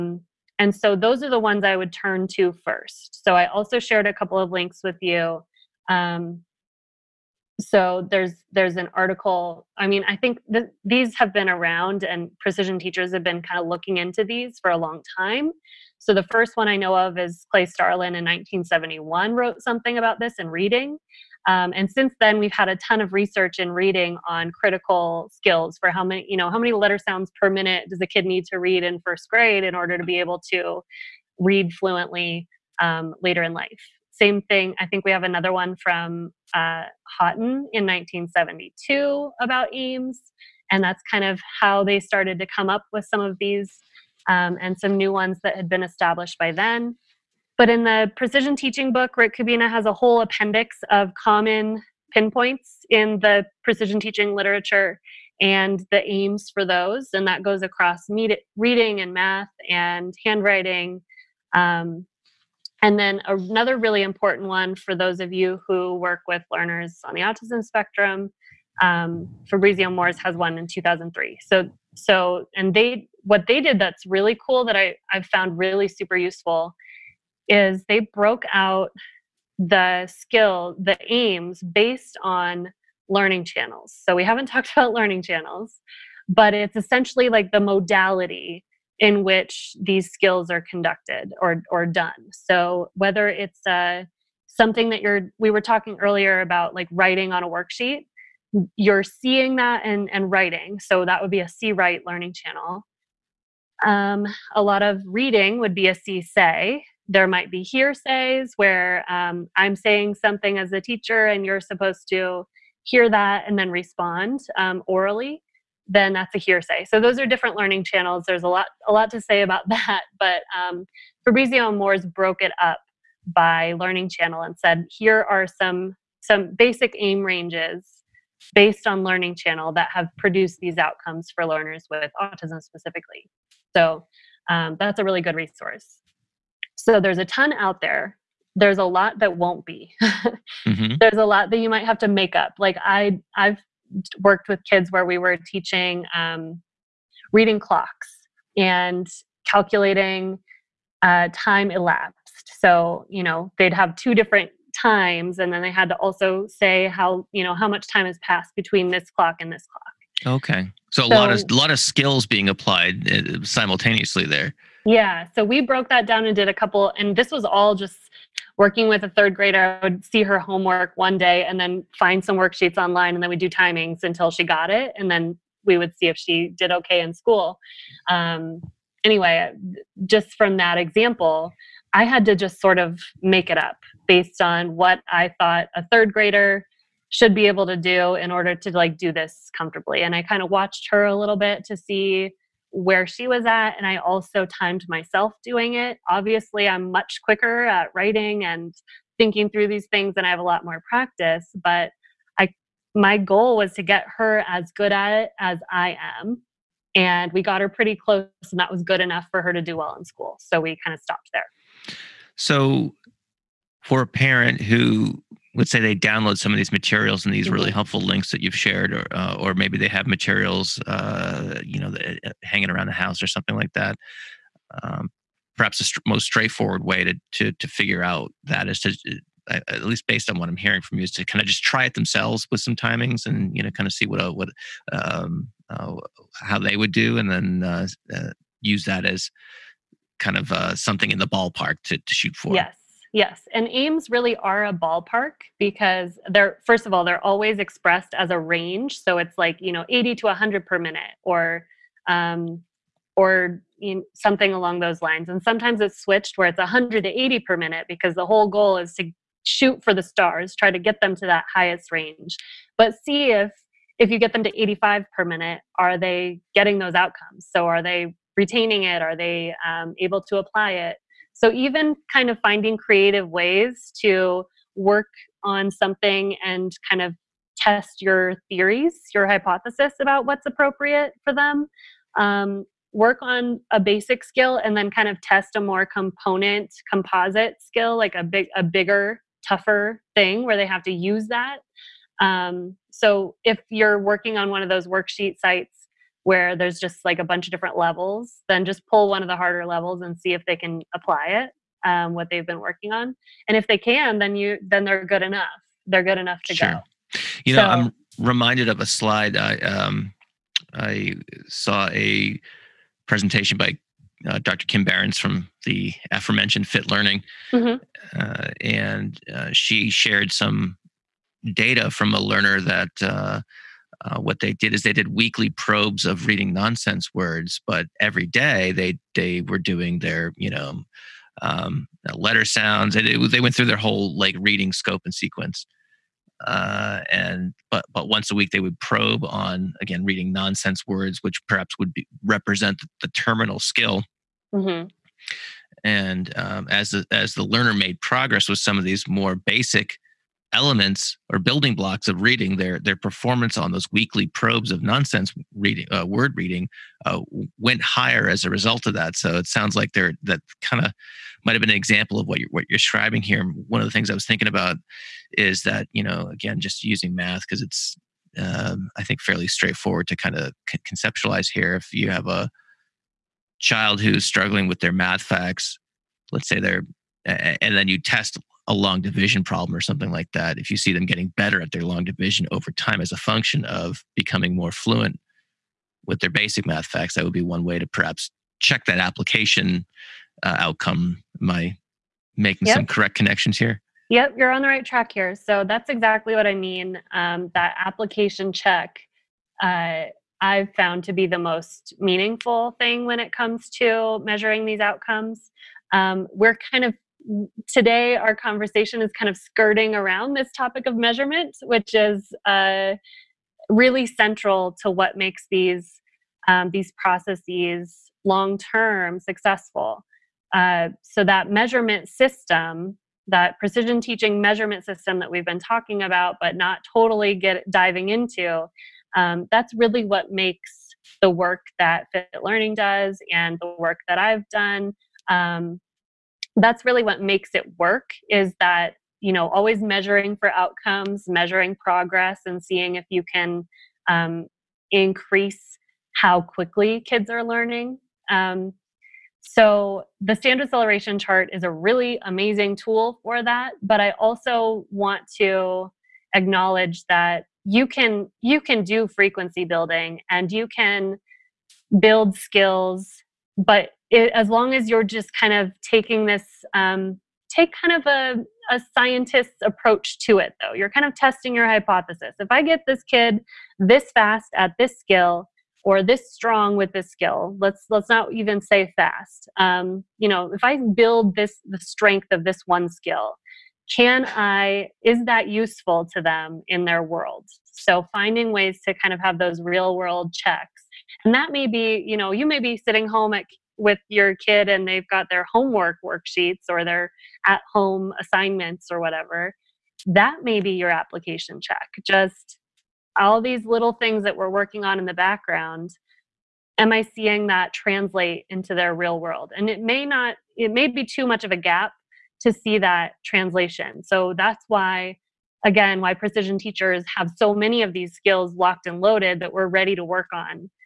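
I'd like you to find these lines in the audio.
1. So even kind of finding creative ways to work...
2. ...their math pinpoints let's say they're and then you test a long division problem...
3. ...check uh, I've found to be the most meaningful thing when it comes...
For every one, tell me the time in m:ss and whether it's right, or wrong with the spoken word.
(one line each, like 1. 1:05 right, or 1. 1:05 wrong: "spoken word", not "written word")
1. 4:31 right
2. 6:14 wrong: "facts", not "pinpoints"
3. 6:38 right.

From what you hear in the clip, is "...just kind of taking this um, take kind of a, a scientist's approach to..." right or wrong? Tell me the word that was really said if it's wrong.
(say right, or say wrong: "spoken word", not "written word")
right.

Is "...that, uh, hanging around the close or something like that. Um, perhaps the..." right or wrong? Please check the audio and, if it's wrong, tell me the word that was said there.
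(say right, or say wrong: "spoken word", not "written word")
wrong: "house", not "close".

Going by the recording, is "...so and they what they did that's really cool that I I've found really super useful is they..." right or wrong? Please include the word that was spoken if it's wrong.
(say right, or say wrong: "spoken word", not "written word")
right.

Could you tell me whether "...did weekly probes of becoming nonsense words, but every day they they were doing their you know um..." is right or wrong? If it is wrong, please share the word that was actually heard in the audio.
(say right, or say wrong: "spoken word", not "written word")
wrong: "reading", not "becoming".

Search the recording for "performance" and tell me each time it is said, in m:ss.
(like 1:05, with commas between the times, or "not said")
5:52.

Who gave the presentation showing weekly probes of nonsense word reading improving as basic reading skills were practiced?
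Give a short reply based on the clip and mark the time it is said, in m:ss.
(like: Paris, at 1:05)
Kim Berens, at 5:14.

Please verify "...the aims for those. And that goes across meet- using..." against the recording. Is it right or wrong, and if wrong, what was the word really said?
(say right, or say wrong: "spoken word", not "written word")
wrong: "reading", not "using".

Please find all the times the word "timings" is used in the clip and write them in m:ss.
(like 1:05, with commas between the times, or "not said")
2:53, 3:52.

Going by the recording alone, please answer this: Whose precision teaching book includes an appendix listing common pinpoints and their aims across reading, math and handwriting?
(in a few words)
Rick Kubina.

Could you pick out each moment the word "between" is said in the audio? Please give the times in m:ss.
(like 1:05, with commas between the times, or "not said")
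2:38.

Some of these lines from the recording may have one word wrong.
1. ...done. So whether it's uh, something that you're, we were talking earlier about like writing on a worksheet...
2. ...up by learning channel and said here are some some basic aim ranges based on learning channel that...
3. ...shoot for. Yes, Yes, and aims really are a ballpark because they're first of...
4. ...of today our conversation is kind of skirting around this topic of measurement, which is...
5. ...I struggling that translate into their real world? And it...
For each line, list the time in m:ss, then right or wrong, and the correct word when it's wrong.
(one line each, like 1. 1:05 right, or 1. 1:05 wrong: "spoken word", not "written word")
1. 1:31 right
2. 2:02 right
3. 4:02 right
4. 6:46 right
5. 8:26 wrong: "seeing", not "struggling".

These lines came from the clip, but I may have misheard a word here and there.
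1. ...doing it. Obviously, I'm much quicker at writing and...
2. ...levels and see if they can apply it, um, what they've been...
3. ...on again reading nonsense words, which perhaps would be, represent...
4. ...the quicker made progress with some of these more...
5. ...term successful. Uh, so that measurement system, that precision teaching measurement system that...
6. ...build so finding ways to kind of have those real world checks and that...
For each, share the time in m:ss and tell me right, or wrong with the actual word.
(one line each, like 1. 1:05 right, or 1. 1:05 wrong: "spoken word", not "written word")
1. 3:15 right
2. 4:59 right
3. 5:39 right
4. 5:47 wrong: "learner", not "quicker"
5. 6:58 right
6. 8:07 wrong: "world", not "build".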